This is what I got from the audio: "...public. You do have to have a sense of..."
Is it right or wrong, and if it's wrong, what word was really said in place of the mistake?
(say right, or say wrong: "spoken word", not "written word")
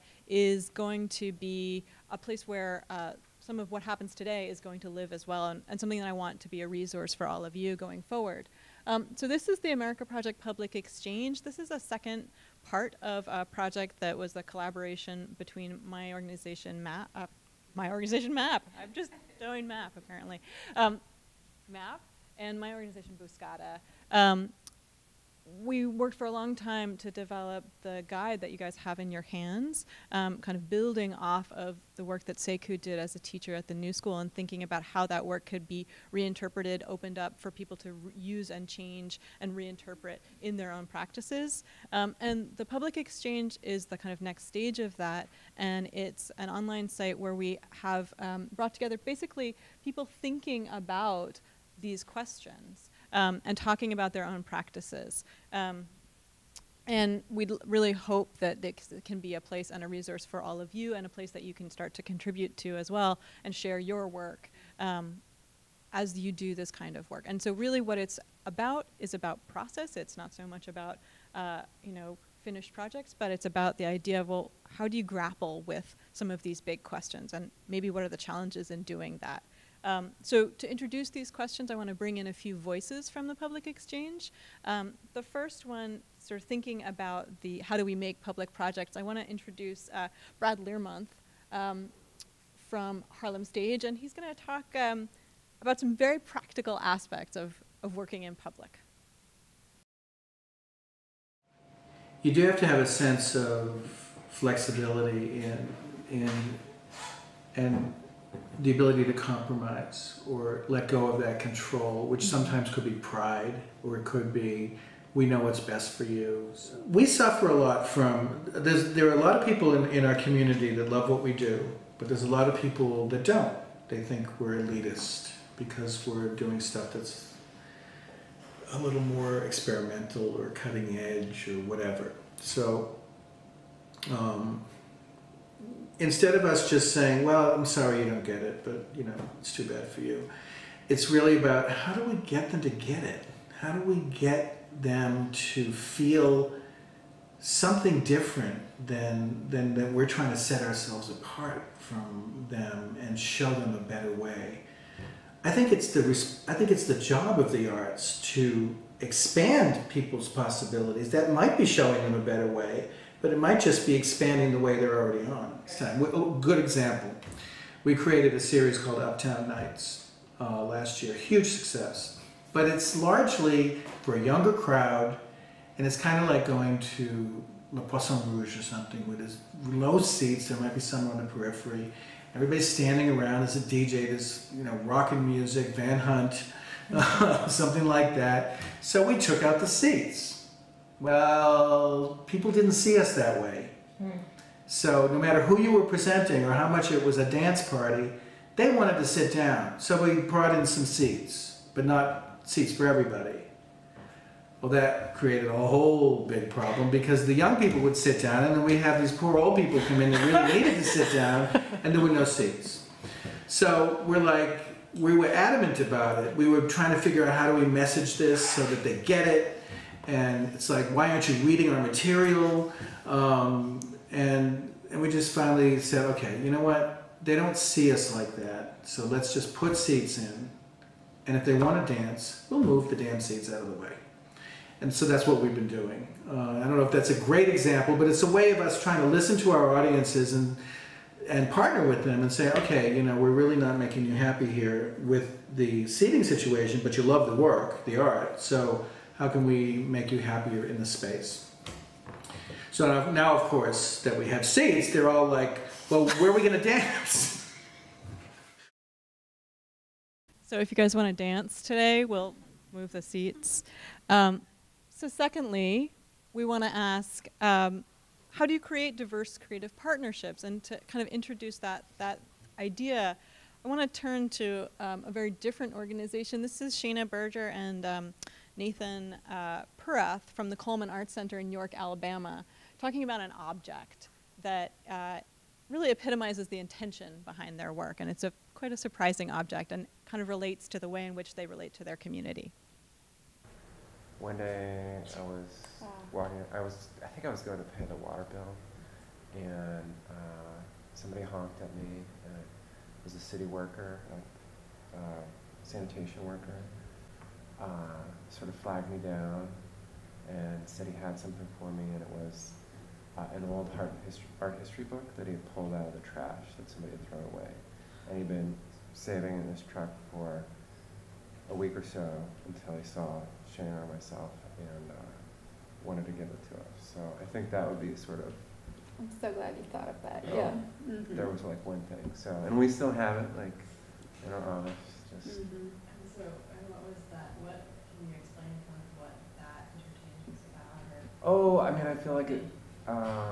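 right.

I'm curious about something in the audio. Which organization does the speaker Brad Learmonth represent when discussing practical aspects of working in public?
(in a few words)
Harlem Stage.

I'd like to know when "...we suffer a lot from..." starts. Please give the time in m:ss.
1:56.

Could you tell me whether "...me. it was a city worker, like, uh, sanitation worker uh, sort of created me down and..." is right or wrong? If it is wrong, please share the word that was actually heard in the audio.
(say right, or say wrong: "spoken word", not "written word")
wrong: "flagged", not "created".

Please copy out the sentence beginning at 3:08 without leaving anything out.
So we took out the seats well, people didn't see us that way.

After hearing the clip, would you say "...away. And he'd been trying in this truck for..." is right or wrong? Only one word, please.
wrong.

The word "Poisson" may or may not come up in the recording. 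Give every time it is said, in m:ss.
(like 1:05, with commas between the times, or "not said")
2:57.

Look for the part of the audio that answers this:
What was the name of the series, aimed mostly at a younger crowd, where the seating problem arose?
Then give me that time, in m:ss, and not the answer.
2:48.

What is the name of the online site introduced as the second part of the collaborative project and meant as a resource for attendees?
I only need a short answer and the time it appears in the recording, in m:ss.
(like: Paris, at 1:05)
America Project Public Exchange, at 0:09.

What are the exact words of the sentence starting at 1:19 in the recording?
Um, so to introduce these questions, I want to bring in a few voices from the public exchange.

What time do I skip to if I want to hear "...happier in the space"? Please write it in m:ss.
4:10.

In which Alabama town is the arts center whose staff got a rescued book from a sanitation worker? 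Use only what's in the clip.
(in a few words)
York.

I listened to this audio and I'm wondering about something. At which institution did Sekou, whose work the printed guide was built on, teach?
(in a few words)
The New School.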